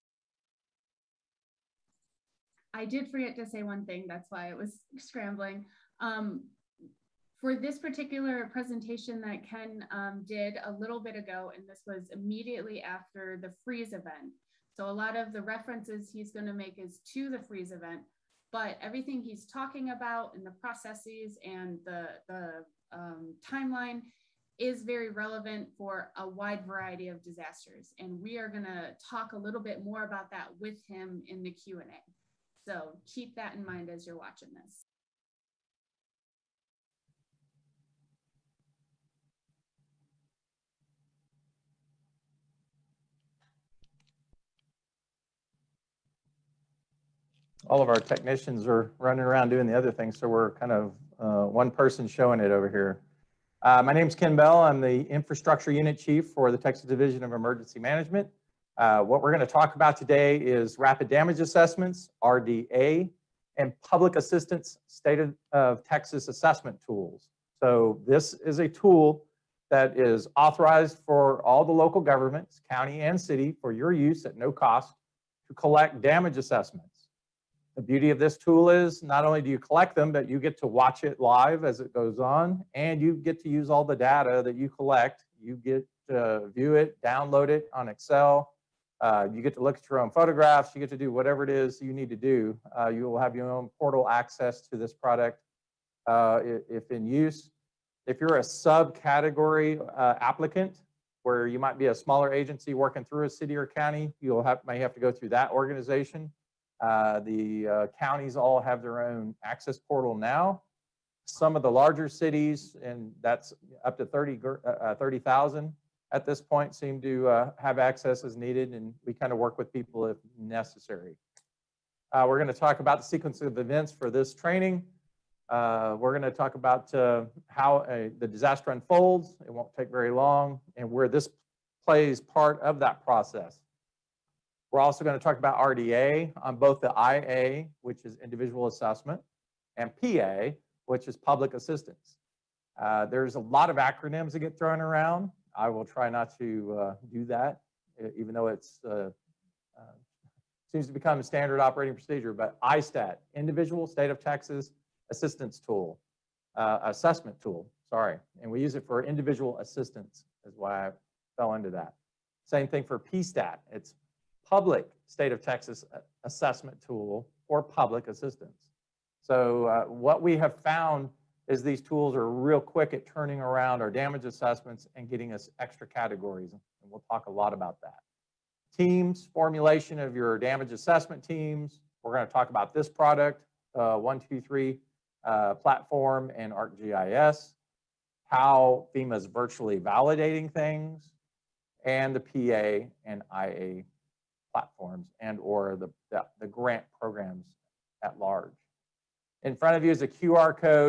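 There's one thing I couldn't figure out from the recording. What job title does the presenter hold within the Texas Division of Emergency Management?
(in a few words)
Infrastructure Unit Chief.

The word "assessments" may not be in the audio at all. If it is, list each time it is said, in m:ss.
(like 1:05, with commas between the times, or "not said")
1:01, 1:06, 1:16, 2:18, 2:36, 2:46, 2:54, 3:00.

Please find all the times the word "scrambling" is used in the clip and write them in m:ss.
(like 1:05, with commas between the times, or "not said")
0:04.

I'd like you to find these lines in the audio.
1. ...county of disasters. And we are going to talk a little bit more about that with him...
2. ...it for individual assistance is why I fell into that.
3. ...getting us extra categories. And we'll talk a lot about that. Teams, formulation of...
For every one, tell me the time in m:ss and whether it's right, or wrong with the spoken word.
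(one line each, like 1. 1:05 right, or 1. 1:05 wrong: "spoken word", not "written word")
1. 0:26 wrong: "variety", not "county"
2. 2:38 right
3. 2:55 right.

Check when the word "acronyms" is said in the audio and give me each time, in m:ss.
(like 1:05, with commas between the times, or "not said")
2:23.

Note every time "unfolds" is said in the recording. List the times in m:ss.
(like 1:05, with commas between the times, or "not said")
2:08.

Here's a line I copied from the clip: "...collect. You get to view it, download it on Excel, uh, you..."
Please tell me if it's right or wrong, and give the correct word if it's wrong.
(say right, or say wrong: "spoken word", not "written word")
right.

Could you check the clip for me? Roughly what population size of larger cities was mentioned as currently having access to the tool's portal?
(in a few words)
30,000.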